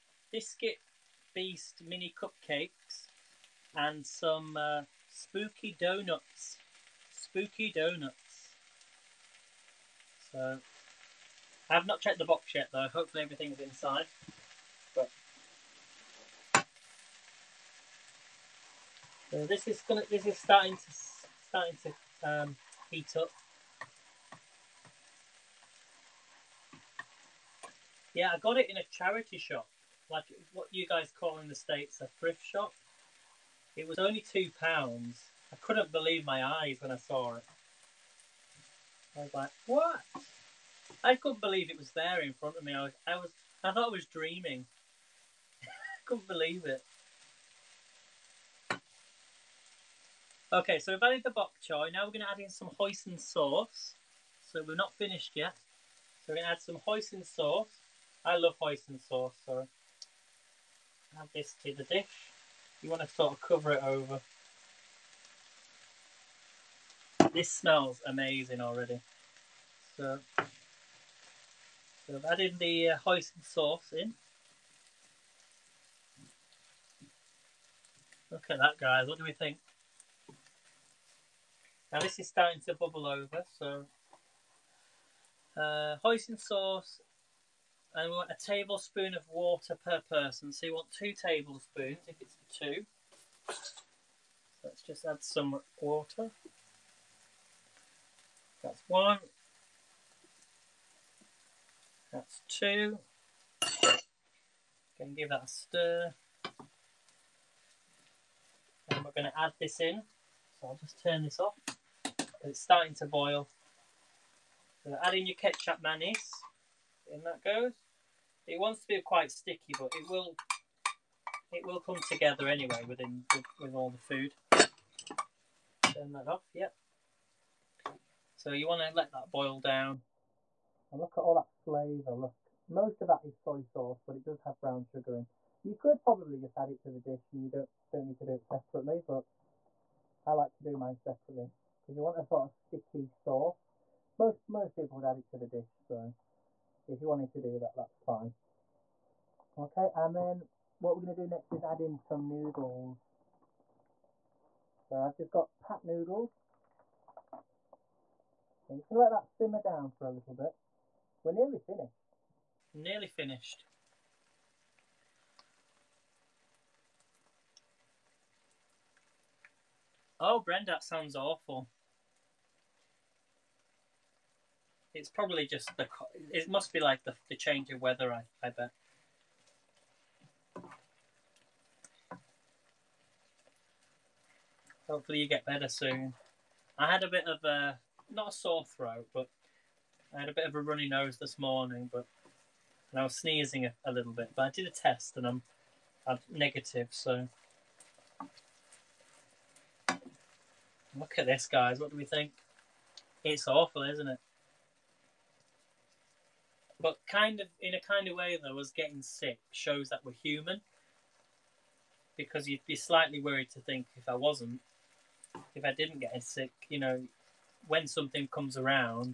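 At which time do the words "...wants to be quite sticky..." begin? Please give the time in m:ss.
1:58.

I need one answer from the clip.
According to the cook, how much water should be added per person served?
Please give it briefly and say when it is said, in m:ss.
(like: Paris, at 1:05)
1 tablespoon, at 1:28.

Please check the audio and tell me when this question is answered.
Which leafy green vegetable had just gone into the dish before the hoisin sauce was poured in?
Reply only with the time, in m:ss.
0:51.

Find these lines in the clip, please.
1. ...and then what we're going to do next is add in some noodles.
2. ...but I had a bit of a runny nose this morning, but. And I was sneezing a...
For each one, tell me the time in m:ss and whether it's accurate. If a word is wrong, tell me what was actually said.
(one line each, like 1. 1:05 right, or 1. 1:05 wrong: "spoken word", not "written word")
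1. 2:29 right
2. 3:09 right.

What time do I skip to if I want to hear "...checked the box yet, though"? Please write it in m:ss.
0:12.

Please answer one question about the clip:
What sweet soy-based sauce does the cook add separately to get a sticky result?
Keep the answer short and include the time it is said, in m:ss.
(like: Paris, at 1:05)
ketjap manis, at 1:55.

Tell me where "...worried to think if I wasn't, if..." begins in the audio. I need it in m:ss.
3:33.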